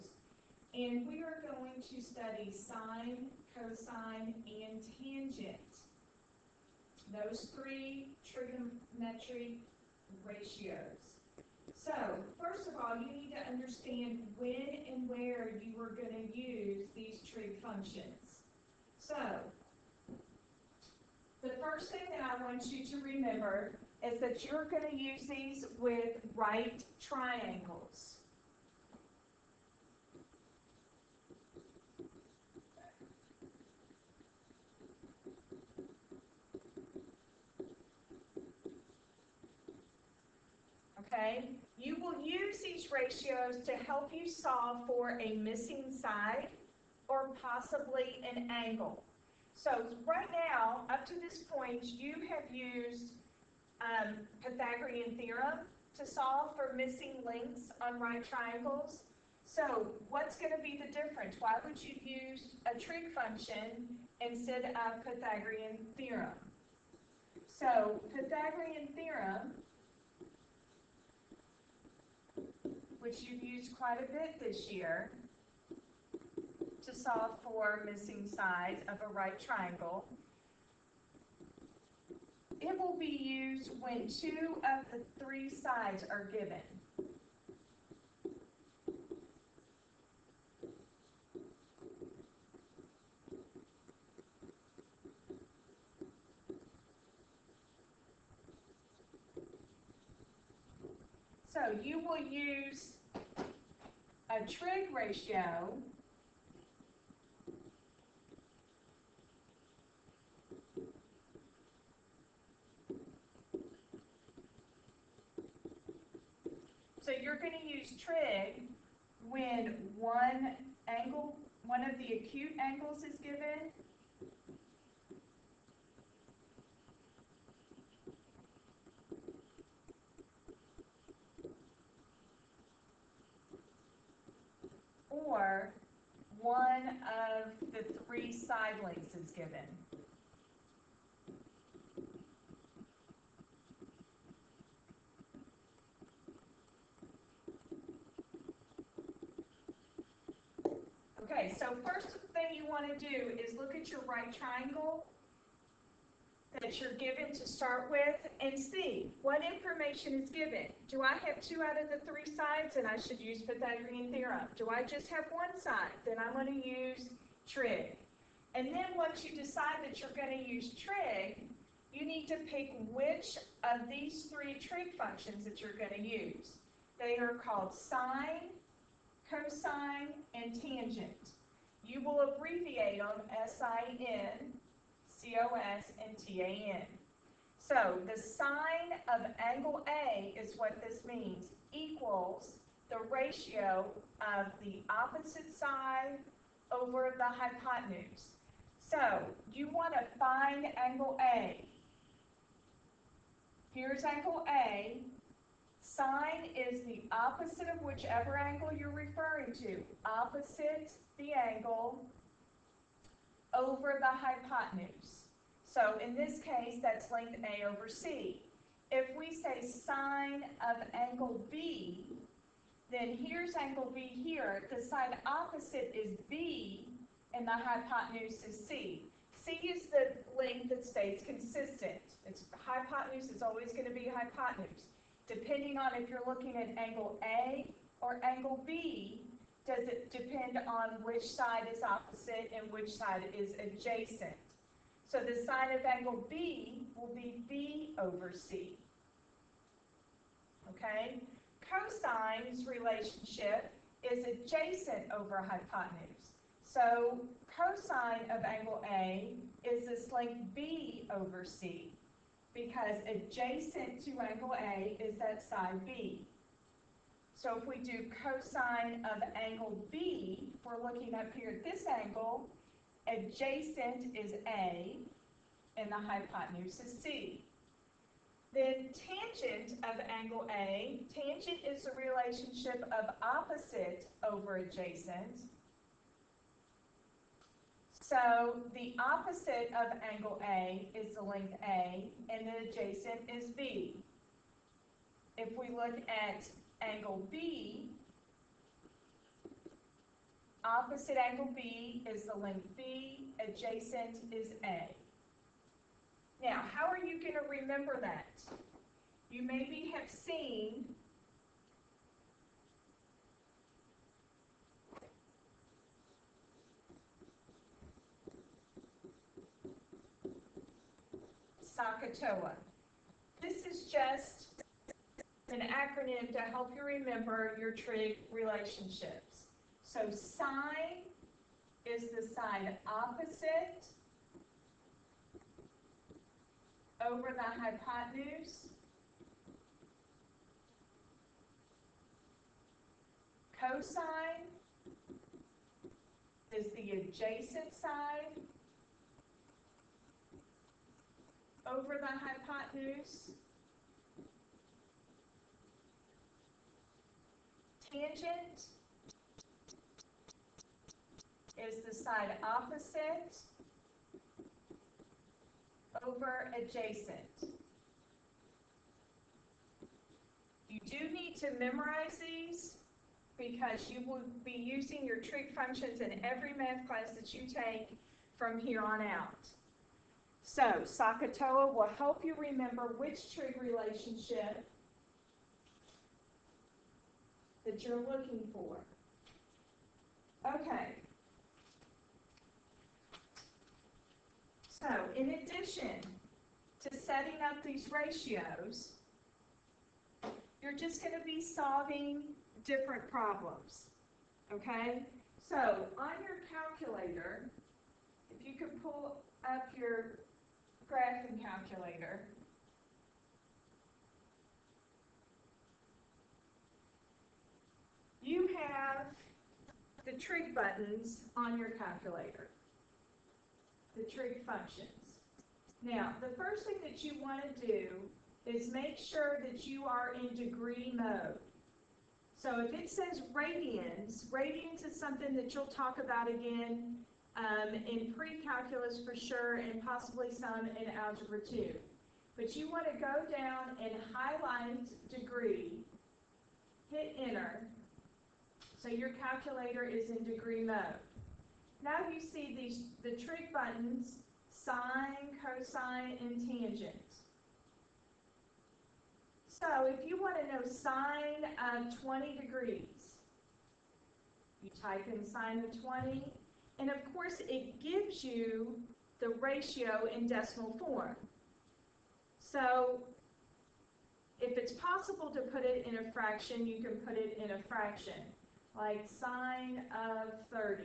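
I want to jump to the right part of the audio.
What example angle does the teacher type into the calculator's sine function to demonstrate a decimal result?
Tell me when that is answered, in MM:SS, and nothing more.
07:42.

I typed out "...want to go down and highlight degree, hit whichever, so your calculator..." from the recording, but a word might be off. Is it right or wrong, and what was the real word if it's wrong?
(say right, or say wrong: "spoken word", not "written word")
wrong: "enter", not "whichever".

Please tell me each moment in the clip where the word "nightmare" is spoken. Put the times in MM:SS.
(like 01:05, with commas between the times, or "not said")
not said.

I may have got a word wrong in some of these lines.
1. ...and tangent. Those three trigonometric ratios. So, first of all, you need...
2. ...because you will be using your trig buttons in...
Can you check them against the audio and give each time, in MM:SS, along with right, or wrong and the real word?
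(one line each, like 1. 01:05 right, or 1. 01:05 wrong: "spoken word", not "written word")
1. 00:04 right
2. 06:13 wrong: "functions", not "buttons".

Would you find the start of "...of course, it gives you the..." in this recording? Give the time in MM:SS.
07:46.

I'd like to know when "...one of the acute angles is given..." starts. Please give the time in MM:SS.
02:01.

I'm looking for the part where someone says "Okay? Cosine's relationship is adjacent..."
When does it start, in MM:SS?
04:10.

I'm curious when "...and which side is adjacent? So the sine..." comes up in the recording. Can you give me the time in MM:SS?
04:02.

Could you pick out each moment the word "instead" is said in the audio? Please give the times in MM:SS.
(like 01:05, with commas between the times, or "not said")
01:04.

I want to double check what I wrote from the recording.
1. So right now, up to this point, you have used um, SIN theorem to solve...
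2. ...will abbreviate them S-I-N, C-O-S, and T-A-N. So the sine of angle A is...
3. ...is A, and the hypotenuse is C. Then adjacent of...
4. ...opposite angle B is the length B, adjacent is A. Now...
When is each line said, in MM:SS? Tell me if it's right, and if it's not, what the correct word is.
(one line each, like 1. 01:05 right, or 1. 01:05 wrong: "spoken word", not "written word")
1. 00:49 wrong: "Pythagorean", not "SIN"
2. 03:02 right
3. 04:34 wrong: "tangent", not "adjacent"
4. 05:00 right.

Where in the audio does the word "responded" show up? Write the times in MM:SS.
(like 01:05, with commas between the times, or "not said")
not said.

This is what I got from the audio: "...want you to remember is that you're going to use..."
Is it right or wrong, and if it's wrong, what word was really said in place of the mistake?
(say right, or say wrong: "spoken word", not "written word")
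right.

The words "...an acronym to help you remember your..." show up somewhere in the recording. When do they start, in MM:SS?
05:25.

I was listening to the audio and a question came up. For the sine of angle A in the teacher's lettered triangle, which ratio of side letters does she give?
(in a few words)
A over C.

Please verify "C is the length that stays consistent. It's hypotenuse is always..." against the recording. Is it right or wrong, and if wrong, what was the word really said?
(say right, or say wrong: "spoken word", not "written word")
right.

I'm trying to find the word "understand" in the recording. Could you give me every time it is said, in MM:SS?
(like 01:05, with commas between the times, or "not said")
00:13.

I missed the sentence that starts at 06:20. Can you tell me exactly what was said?
So SOHCAHTOA will help you remember which trig relationship that you're looking for.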